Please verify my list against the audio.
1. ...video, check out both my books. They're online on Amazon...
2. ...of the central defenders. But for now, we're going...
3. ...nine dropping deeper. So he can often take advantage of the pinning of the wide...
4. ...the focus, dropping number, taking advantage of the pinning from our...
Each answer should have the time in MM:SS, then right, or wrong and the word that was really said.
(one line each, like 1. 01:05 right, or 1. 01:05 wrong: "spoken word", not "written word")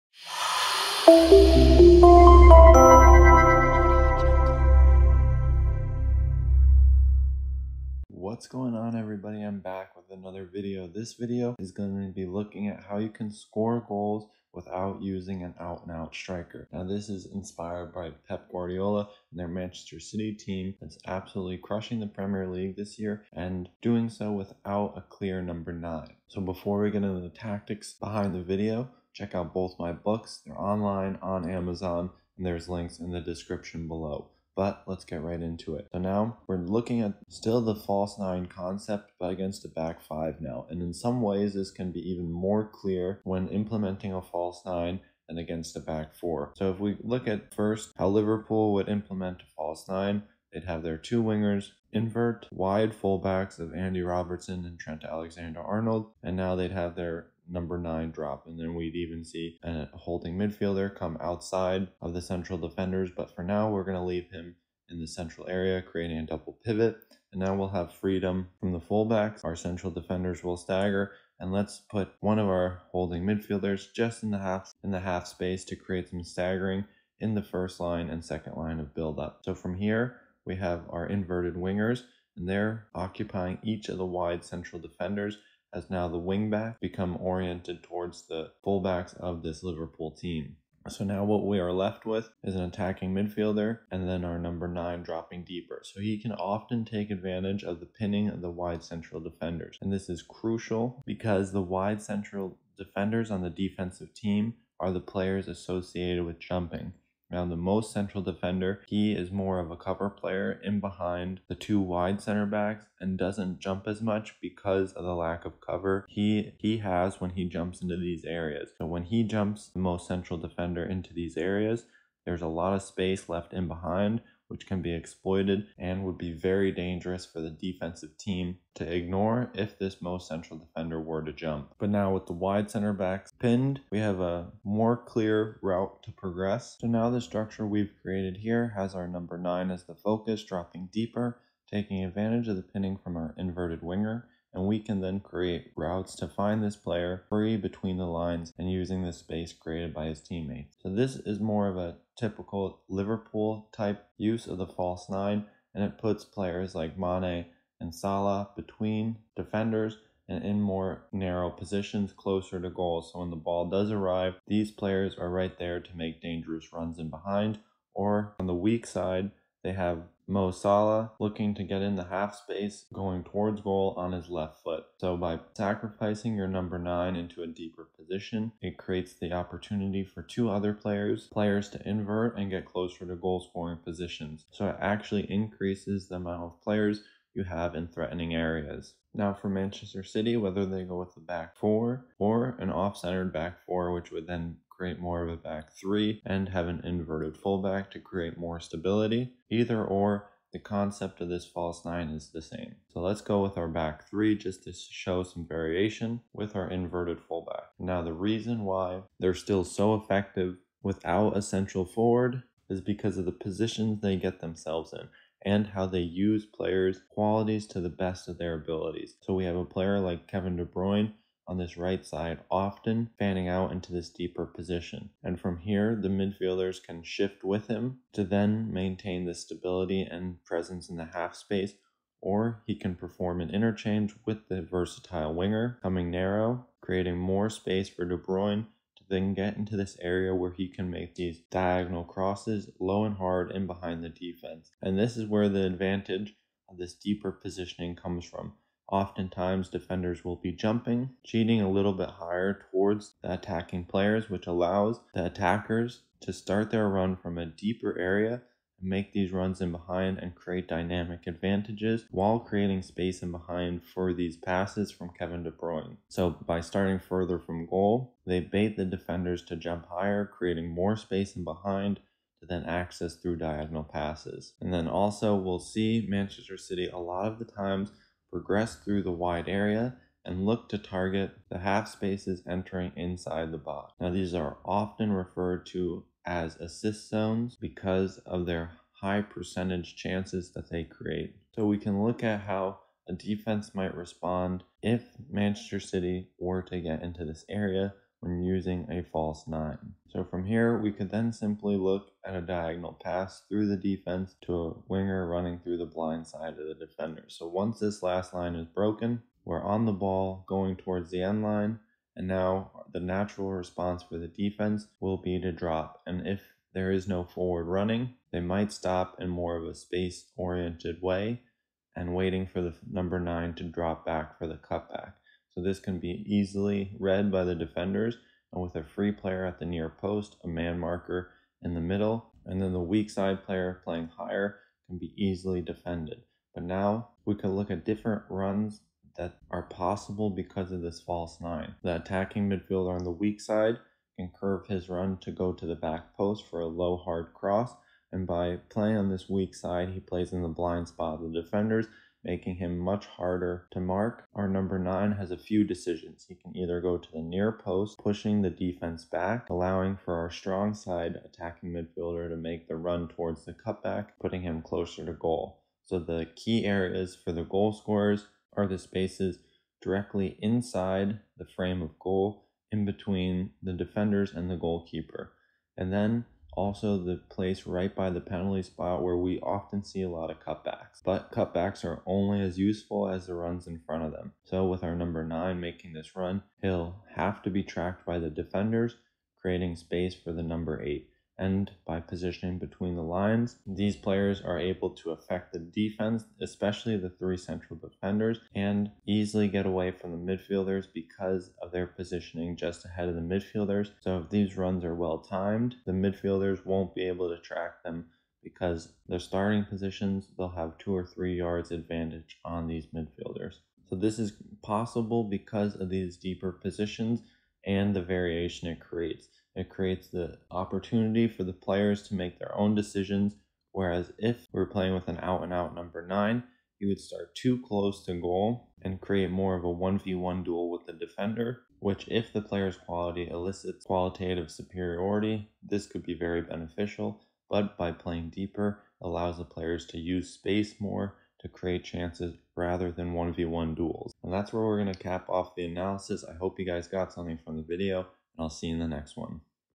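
1. 00:28 right
2. 01:02 right
3. 01:34 right
4. 02:19 wrong: "deeper", not "number".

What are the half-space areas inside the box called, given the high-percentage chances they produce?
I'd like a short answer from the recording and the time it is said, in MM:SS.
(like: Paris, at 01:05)
assist zones, at 04:46.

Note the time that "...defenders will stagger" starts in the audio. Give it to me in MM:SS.
01:09.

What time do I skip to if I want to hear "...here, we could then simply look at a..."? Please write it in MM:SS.
05:00.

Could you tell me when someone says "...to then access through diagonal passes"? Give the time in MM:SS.
04:32.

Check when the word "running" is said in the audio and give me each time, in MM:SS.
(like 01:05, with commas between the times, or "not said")
05:05, 05:17.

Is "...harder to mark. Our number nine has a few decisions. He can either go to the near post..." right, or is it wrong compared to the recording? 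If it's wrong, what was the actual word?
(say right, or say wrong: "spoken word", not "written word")
right.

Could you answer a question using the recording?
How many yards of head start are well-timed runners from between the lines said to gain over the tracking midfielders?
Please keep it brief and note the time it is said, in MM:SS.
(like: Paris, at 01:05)
2 or 3 yards, at 06:50.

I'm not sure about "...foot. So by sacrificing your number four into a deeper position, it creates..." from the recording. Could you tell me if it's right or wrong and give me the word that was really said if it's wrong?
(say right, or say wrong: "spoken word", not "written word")
wrong: "nine", not "four".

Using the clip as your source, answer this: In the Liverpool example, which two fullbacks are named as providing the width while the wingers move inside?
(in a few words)
Andy Robertson and Trent Alexander Arnold.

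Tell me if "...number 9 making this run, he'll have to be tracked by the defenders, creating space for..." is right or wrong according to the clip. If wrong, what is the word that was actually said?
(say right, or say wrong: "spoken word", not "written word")
right.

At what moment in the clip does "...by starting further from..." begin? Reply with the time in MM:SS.
04:26.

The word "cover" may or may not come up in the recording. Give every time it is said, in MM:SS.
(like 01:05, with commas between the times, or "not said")
01:49, 01:55.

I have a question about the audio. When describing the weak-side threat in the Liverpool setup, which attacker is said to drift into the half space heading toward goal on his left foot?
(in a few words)
Mo Salah.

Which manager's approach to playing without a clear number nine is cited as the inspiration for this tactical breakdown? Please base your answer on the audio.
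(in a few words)
Pep Guardiola.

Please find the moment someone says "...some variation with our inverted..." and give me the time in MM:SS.
03:25.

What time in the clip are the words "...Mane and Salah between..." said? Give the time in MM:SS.
02:36.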